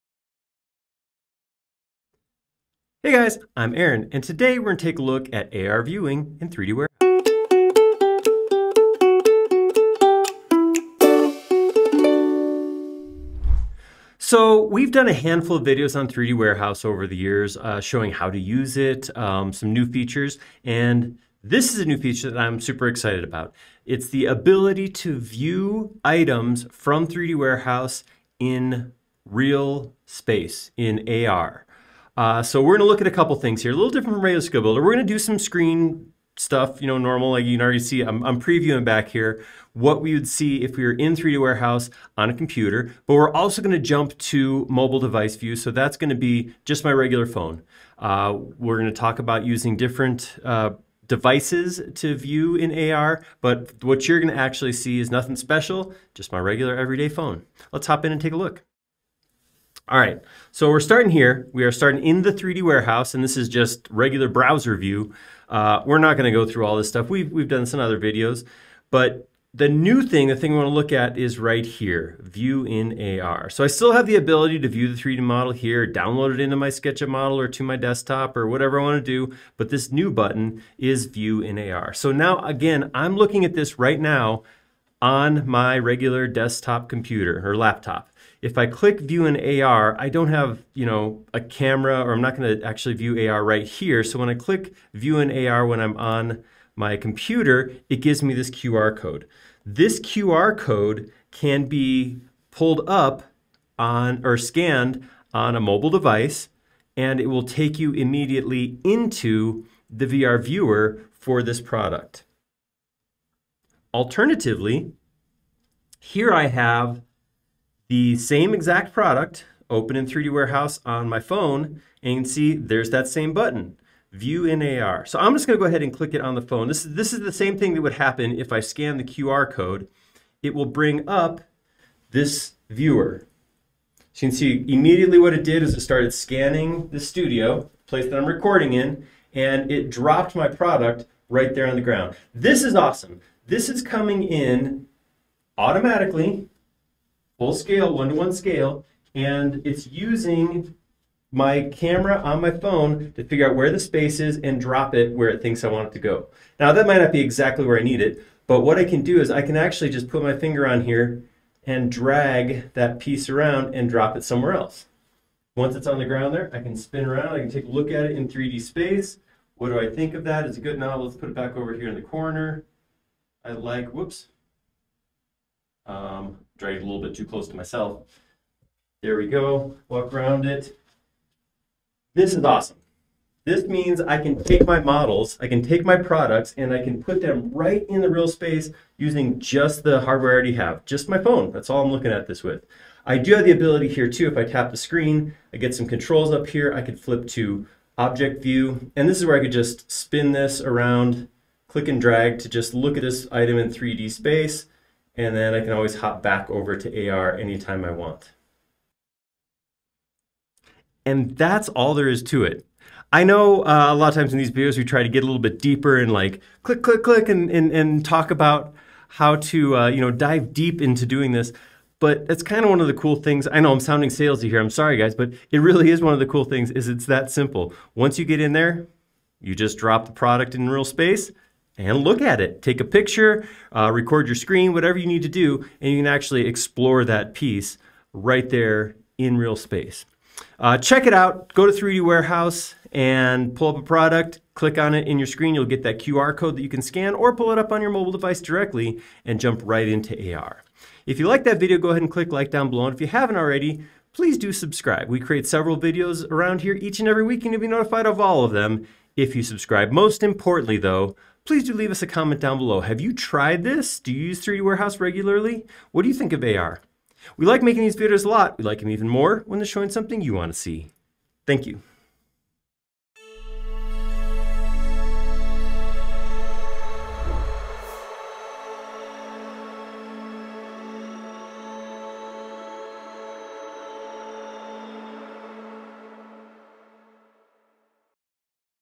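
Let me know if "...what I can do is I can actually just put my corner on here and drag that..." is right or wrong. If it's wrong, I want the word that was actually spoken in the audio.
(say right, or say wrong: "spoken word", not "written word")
wrong: "finger", not "corner".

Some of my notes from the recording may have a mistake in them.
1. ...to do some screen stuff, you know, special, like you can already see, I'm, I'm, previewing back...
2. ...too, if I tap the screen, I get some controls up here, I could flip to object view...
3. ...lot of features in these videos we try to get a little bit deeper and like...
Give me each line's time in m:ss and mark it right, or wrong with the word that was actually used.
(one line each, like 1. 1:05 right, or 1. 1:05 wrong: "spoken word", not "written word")
1. 0:35 wrong: "normal", not "special"
2. 3:14 right
3. 3:33 wrong: "times", not "features".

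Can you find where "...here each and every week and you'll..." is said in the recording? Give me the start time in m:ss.
4:16.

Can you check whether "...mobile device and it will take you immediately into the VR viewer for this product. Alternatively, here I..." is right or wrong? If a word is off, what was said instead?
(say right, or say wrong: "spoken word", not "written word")
right.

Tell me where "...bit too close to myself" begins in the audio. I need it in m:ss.
2:57.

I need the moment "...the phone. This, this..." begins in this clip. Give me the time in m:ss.
2:06.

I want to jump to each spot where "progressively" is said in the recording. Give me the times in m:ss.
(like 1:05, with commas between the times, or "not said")
not said.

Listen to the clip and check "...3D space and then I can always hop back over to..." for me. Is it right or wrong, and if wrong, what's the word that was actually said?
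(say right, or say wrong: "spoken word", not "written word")
right.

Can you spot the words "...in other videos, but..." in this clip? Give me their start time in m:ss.
1:07.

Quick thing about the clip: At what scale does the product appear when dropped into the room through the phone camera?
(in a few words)
One-to-one.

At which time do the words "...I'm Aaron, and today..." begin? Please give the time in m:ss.
0:03.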